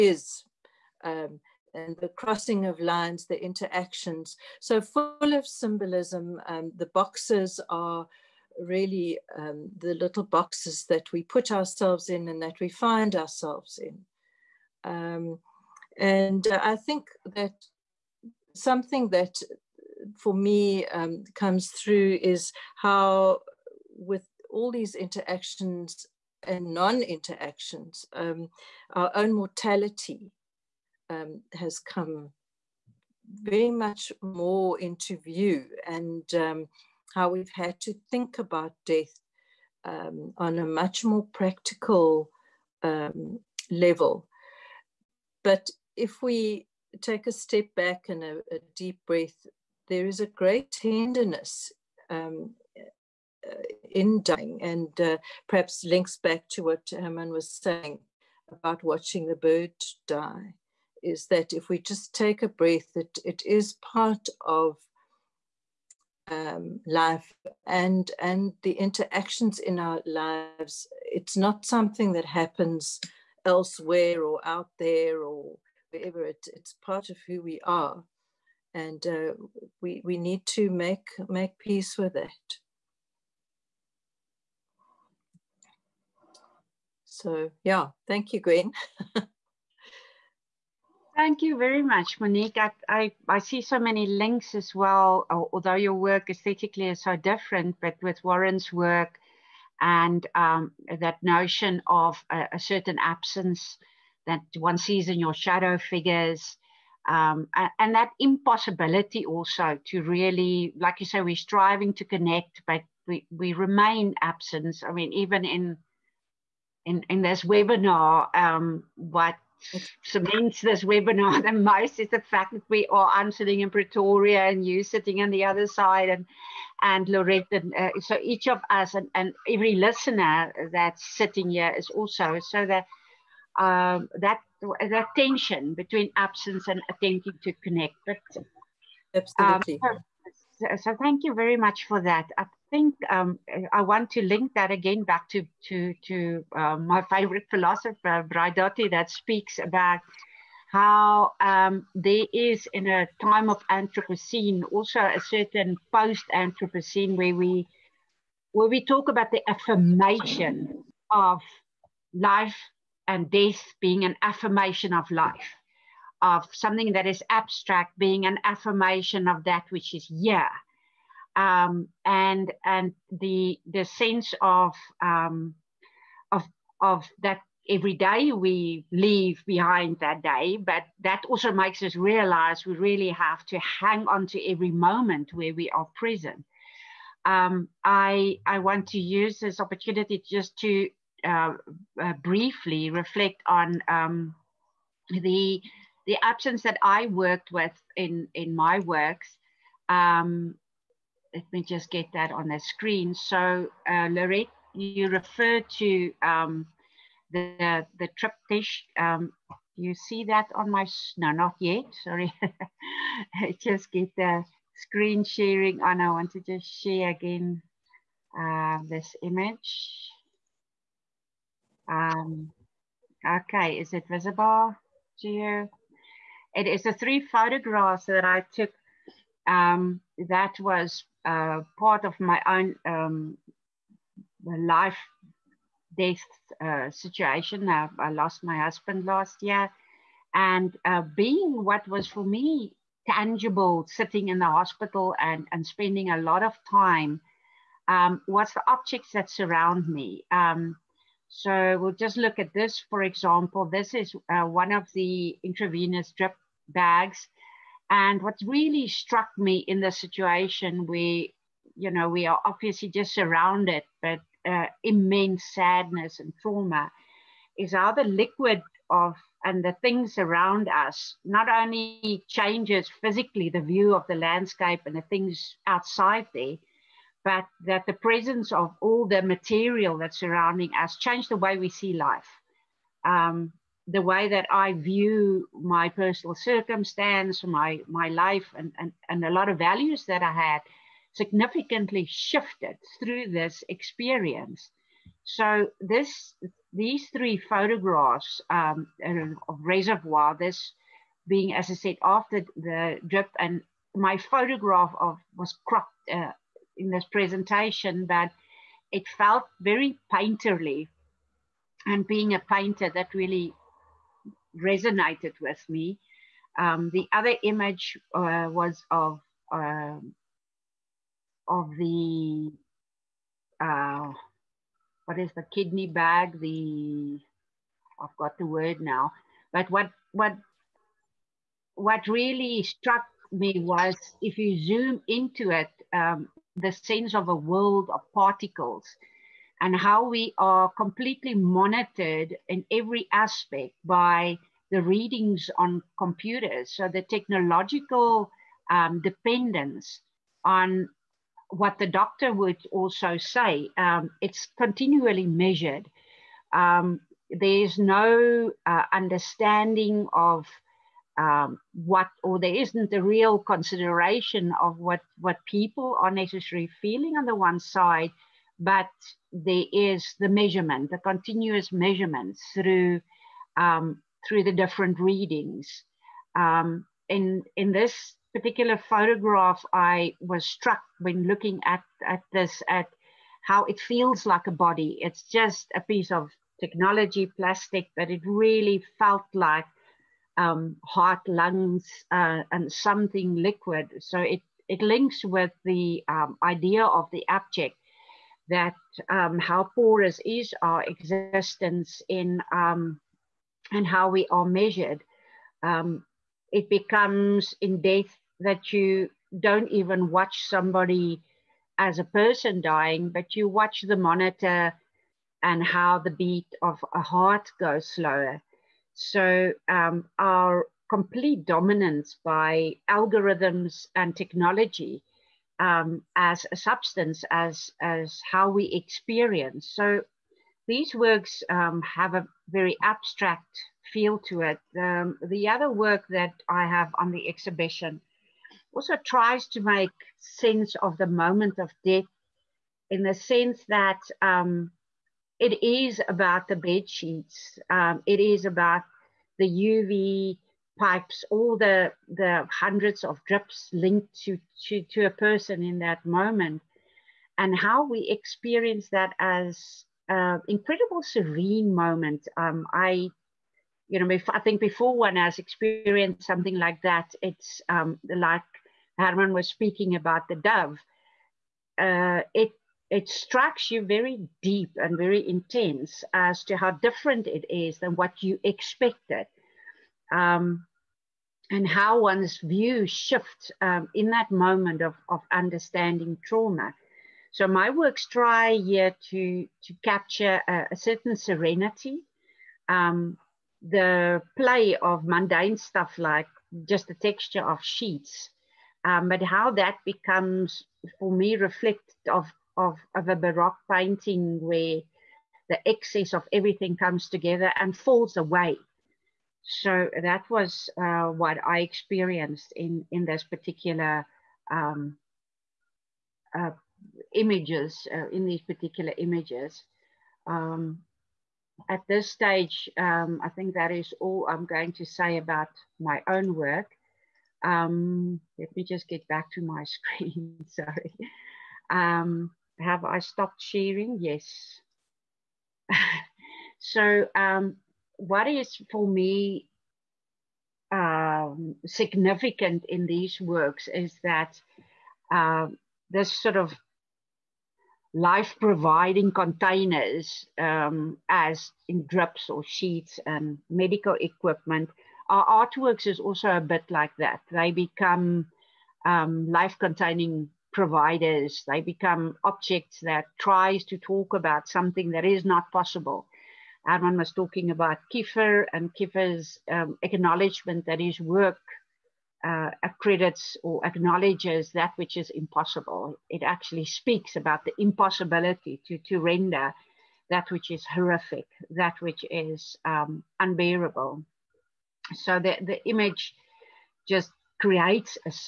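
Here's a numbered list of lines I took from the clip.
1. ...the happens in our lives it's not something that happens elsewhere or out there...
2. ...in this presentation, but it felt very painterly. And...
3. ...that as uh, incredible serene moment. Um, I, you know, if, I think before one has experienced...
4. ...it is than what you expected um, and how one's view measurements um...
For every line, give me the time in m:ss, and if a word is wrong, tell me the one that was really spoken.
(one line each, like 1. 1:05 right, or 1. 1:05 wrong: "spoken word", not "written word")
1. 1:08 wrong: "interactions", not "happens"
2. 5:06 right
3. 7:38 right
4. 7:57 wrong: "shifts", not "measurements".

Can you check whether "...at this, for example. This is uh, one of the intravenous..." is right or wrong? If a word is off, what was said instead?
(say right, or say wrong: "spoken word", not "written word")
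right.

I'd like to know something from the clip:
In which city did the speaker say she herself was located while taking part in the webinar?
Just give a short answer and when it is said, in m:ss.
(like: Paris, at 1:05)
Pretoria, at 2:03.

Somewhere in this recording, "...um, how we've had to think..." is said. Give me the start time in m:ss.
0:36.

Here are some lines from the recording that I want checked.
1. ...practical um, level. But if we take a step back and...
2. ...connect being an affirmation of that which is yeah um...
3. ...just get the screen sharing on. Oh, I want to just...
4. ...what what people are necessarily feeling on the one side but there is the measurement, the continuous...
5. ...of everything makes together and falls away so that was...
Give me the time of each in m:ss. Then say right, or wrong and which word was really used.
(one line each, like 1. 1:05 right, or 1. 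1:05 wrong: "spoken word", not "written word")
1. 0:41 right
2. 2:47 wrong: "abstract", not "connect"
3. 3:33 right
4. 6:04 right
5. 8:26 wrong: "comes", not "makes".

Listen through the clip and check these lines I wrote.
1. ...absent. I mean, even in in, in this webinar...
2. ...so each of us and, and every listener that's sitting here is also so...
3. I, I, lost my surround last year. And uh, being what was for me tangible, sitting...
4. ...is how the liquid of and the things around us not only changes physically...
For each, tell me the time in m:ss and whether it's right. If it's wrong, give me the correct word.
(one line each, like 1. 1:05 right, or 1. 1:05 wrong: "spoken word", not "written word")
1. 1:54 right
2. 2:08 right
3. 3:57 wrong: "husband", not "surround"
4. 4:27 right.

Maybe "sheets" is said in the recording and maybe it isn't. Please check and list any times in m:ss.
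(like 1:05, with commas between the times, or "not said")
7:26, 8:17, 9:12.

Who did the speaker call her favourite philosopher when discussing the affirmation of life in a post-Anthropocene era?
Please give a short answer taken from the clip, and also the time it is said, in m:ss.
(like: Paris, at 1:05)
Braidotti, at 2:28.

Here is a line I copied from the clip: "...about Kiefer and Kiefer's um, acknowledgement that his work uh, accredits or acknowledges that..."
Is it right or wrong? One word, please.
right.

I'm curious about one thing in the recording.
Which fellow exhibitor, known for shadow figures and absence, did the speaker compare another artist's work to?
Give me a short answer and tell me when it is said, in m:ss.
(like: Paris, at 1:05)
Warren, at 1:38.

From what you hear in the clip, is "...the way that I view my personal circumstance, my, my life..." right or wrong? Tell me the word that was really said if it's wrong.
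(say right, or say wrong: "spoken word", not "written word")
right.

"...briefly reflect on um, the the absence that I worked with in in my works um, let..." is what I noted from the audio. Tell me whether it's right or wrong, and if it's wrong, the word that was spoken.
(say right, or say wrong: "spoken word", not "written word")
right.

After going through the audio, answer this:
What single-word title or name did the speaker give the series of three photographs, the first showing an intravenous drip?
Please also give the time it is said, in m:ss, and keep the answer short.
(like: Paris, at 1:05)
Reservoir, at 4:59.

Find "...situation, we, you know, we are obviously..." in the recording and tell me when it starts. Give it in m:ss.
4:19.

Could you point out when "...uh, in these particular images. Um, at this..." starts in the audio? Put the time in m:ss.
8:37.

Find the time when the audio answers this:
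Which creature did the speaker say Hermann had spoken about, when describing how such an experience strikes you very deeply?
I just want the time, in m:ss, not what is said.
7:50.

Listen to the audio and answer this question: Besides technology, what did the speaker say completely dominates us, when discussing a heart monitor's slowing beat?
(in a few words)
algorithms.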